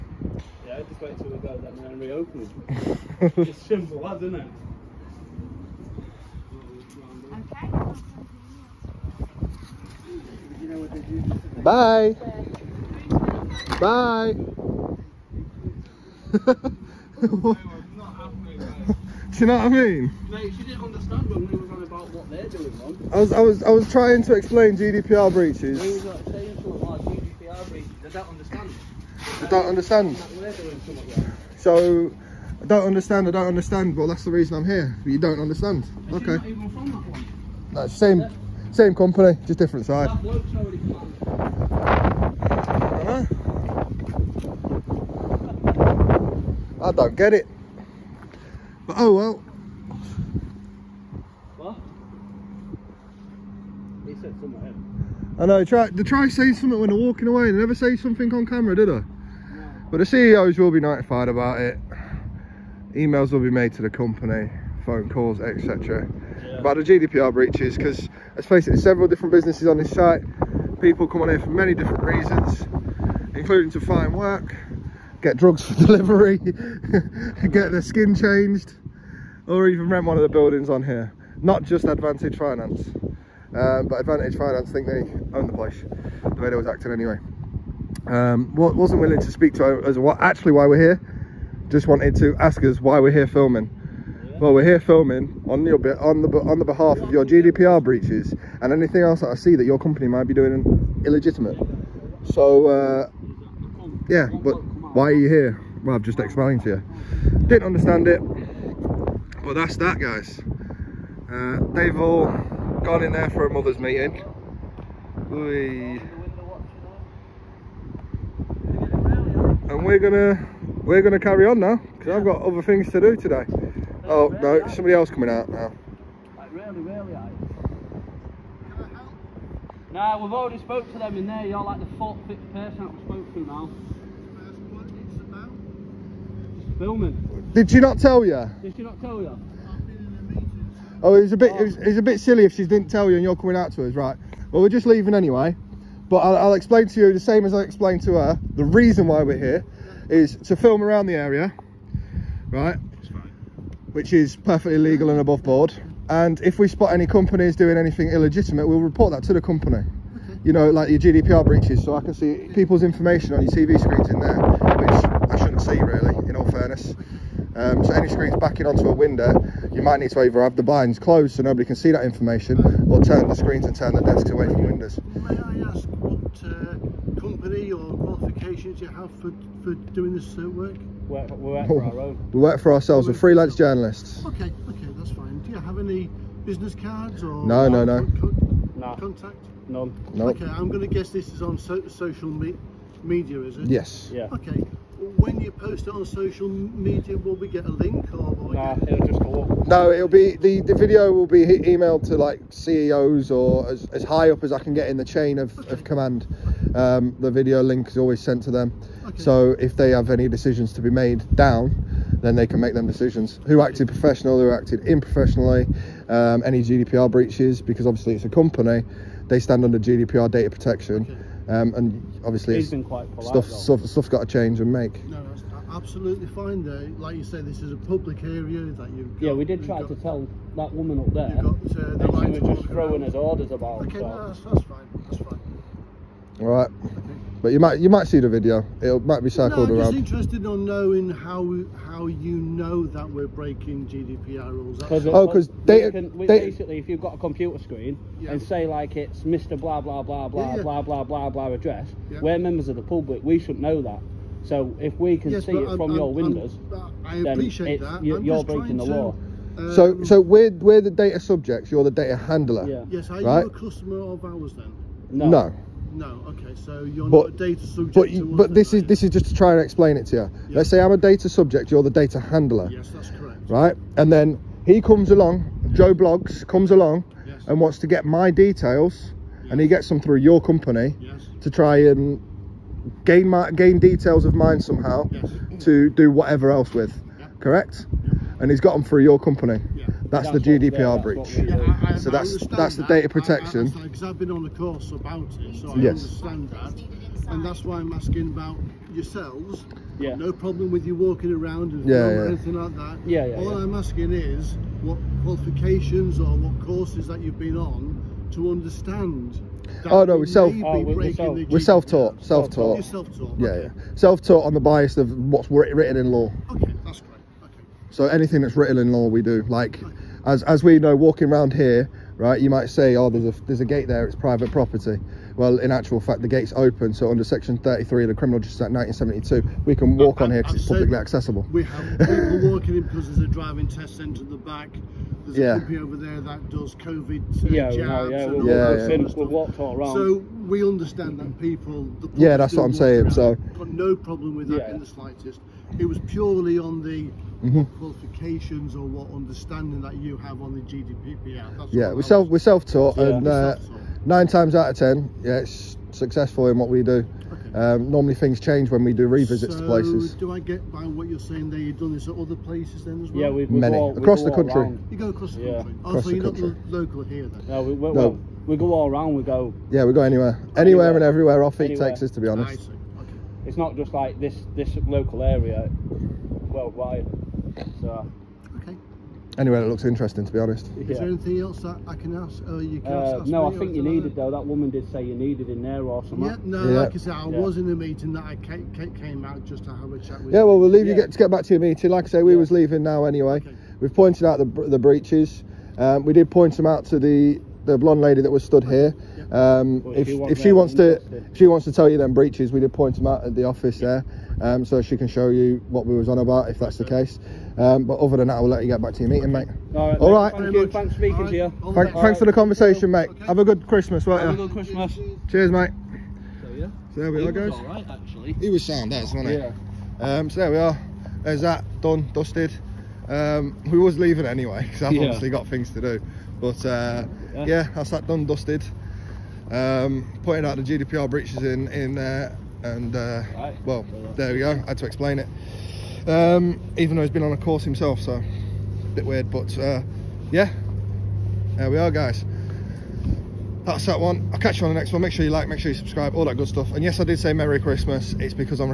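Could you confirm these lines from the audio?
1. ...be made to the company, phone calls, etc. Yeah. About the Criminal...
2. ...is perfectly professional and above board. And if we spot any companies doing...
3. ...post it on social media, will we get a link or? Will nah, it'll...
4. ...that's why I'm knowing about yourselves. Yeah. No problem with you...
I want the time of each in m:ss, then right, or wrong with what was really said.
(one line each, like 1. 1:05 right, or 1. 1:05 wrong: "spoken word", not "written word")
1. 1:03 wrong: "GDPR", not "Criminal"
2. 2:34 wrong: "legal", not "professional"
3. 3:15 right
4. 4:57 wrong: "asking", not "knowing".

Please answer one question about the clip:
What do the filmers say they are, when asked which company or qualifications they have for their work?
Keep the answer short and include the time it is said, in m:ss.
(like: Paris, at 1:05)
freelance journalists, at 3:03.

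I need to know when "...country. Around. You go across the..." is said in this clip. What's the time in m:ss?
6:04.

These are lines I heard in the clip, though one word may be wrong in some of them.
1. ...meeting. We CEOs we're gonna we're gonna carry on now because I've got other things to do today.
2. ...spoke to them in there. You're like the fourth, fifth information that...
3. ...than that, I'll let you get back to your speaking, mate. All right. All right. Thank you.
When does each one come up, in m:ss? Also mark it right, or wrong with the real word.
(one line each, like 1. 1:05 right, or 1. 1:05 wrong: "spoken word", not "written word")
1. 1:53 wrong: "And", not "CEOs"
2. 2:10 wrong: "person", not "information"
3. 6:48 wrong: "meeting", not "speaking".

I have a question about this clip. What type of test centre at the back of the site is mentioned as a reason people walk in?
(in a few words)
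driving test centre.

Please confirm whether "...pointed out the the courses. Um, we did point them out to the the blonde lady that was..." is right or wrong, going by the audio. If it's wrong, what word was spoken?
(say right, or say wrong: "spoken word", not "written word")
wrong: "breaches", not "courses".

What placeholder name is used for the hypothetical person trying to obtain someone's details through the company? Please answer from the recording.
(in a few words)
Joe Bloggs.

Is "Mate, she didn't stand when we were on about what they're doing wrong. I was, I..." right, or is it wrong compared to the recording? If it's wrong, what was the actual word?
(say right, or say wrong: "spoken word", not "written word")
wrong: "understand", not "stand".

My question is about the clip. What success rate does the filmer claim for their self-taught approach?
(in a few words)
9 times out of 10.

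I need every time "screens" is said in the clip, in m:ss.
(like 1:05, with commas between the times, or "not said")
2:43, 2:48, 2:53, 4:07.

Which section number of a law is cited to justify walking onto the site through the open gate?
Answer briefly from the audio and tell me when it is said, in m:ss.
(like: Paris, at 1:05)
33, at 5:27.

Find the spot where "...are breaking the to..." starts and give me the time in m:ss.
4:18.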